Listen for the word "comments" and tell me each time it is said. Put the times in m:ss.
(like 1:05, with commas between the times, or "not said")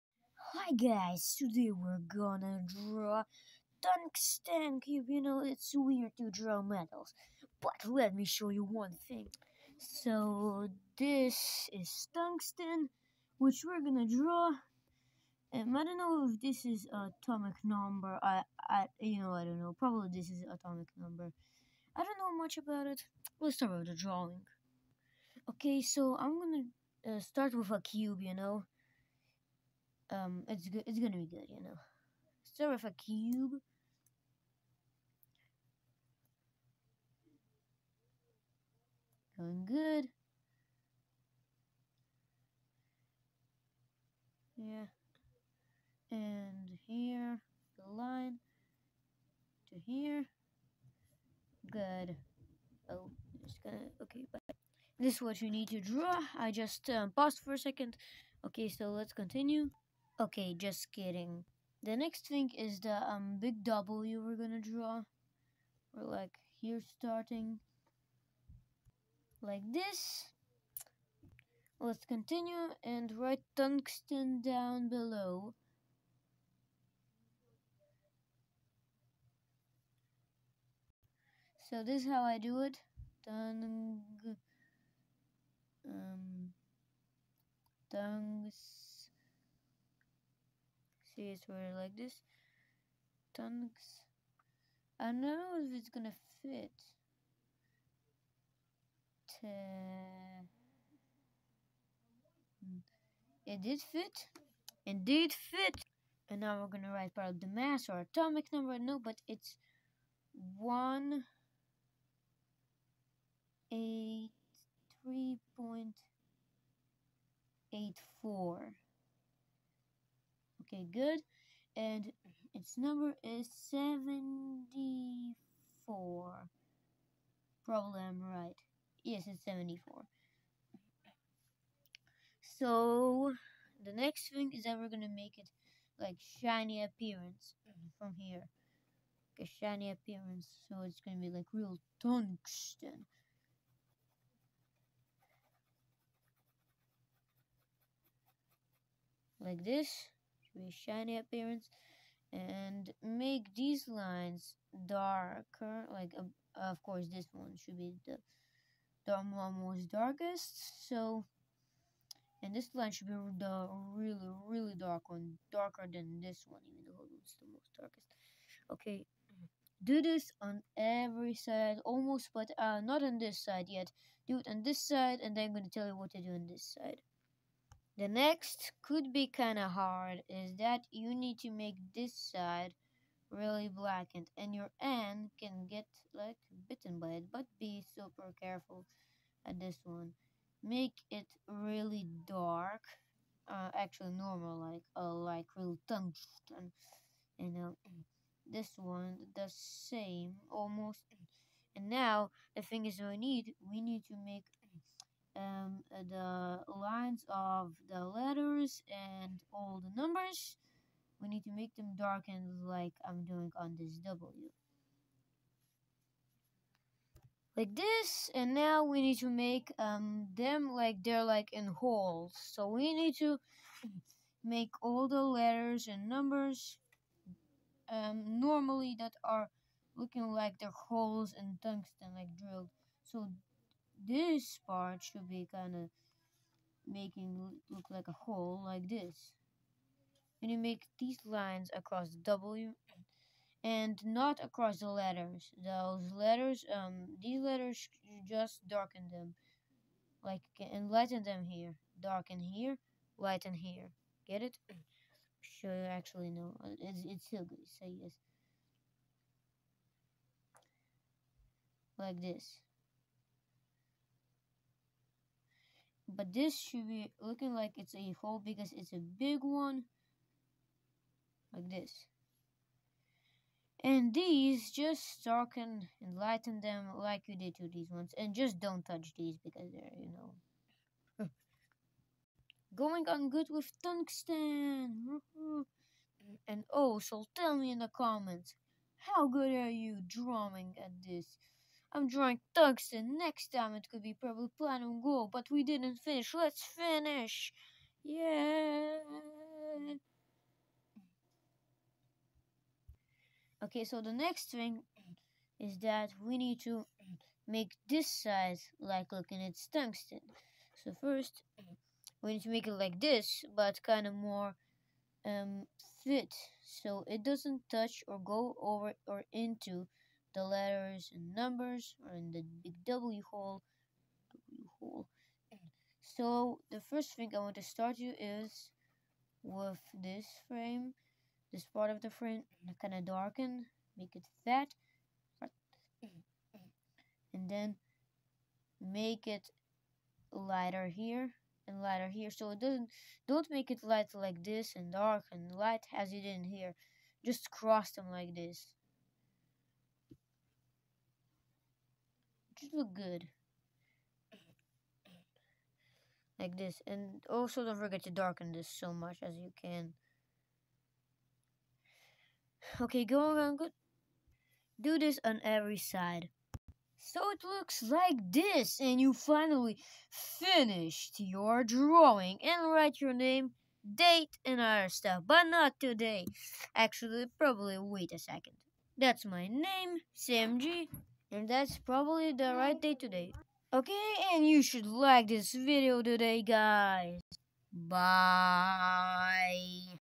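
4:47.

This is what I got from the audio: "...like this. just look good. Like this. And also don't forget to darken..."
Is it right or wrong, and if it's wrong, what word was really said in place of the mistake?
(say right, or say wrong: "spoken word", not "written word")
right.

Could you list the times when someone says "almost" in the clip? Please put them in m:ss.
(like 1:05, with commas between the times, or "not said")
2:51, 3:20.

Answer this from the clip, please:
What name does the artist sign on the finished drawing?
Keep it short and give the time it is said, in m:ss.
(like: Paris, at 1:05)
Sam G, at 6:20.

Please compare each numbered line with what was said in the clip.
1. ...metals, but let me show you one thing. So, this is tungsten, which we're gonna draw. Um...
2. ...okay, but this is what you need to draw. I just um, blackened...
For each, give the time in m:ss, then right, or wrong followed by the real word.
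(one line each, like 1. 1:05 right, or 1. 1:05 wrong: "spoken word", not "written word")
1. 0:06 right
2. 0:54 wrong: "paused", not "blackened".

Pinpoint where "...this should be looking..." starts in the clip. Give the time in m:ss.
4:26.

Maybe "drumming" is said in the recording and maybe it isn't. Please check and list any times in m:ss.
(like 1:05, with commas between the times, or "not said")
4:50.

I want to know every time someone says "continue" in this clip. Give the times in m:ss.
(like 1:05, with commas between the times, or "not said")
0:59, 1:12.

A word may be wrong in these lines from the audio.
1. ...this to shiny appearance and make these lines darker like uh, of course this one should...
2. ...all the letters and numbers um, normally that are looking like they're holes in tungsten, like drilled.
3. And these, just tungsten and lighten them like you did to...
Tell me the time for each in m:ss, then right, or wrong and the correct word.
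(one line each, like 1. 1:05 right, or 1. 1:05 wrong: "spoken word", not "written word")
1. 2:29 right
2. 3:44 right
3. 4:33 wrong: "darken", not "tungsten".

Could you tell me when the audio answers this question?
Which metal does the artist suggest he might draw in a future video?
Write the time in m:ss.
4:54.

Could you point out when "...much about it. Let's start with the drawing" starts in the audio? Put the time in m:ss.
0:22.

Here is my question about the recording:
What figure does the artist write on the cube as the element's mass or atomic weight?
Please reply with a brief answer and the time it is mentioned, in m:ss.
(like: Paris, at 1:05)
183.84, at 1:50.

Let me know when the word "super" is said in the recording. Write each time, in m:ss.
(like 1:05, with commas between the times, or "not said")
3:07.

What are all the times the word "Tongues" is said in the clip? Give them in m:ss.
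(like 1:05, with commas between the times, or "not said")
1:33.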